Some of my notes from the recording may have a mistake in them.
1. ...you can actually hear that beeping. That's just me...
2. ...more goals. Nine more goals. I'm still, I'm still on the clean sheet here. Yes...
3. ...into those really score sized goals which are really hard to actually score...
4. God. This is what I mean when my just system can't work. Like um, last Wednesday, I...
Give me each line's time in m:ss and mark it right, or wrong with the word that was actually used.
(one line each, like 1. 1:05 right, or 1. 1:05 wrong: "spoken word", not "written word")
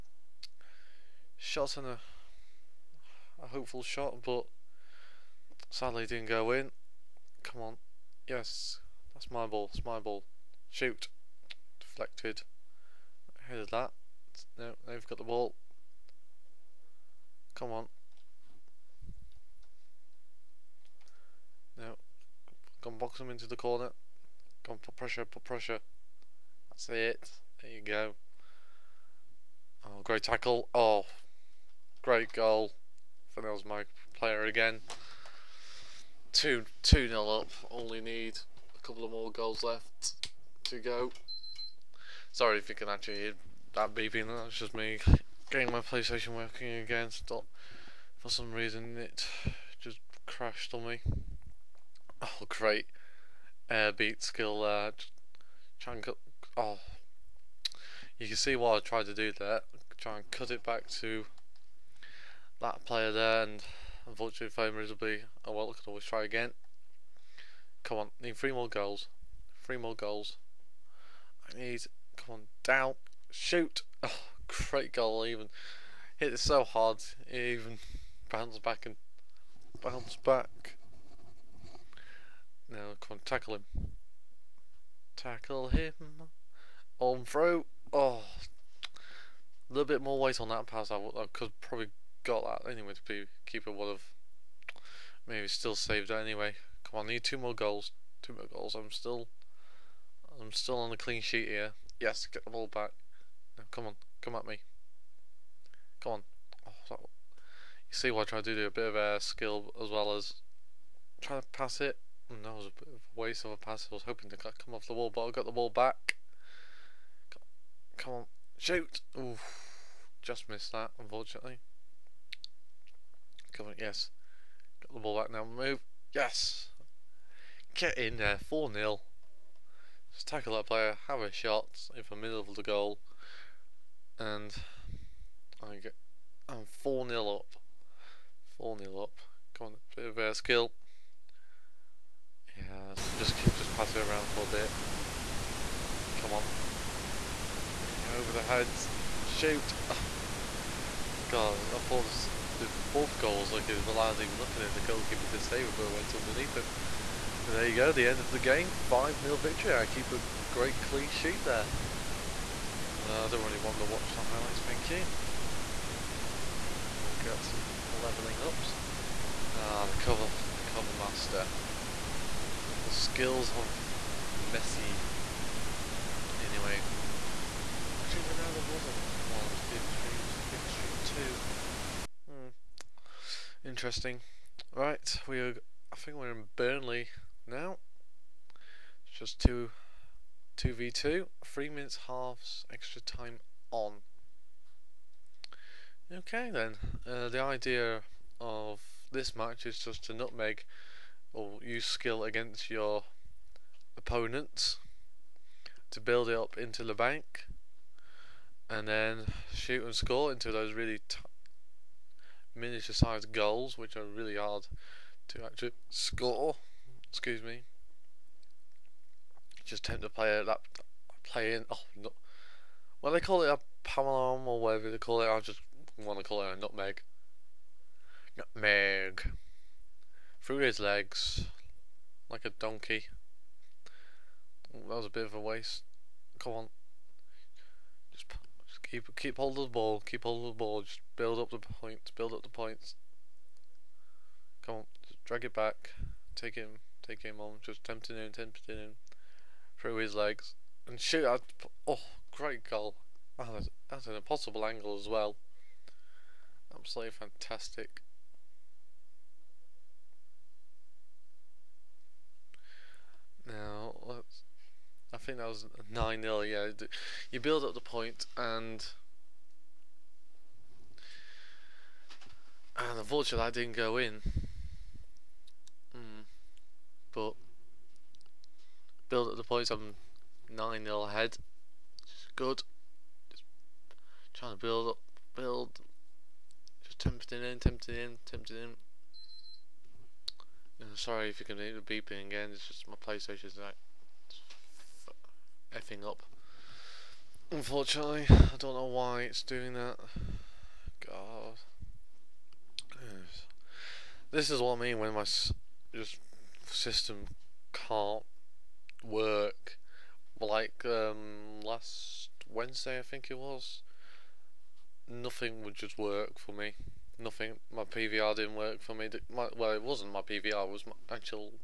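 1. 0:42 right
2. 1:37 wrong: "Two", not "Nine"
3. 3:30 wrong: "miniature", not "score"
4. 5:01 right.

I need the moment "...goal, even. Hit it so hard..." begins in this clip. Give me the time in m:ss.
1:14.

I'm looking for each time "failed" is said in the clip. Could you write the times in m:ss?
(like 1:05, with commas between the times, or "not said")
1:04.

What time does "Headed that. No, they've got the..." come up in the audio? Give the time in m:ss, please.
0:13.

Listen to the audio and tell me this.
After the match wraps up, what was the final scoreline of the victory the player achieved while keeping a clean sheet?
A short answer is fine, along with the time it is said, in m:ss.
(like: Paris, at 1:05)
5 0, at 2:38.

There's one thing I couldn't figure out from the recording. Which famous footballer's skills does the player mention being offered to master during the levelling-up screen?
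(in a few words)
Messi.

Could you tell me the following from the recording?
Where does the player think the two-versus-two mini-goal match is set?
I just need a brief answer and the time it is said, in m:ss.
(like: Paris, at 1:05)
Burnley, at 3:06.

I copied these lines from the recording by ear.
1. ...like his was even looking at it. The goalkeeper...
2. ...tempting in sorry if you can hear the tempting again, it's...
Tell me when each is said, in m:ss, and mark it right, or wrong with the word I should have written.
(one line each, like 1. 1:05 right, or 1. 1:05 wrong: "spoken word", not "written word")
1. 2:33 right
2. 4:48 wrong: "beeping", not "tempting".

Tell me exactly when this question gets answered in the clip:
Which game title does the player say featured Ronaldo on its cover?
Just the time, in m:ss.
3:00.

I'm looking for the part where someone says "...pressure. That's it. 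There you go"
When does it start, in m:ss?
0:25.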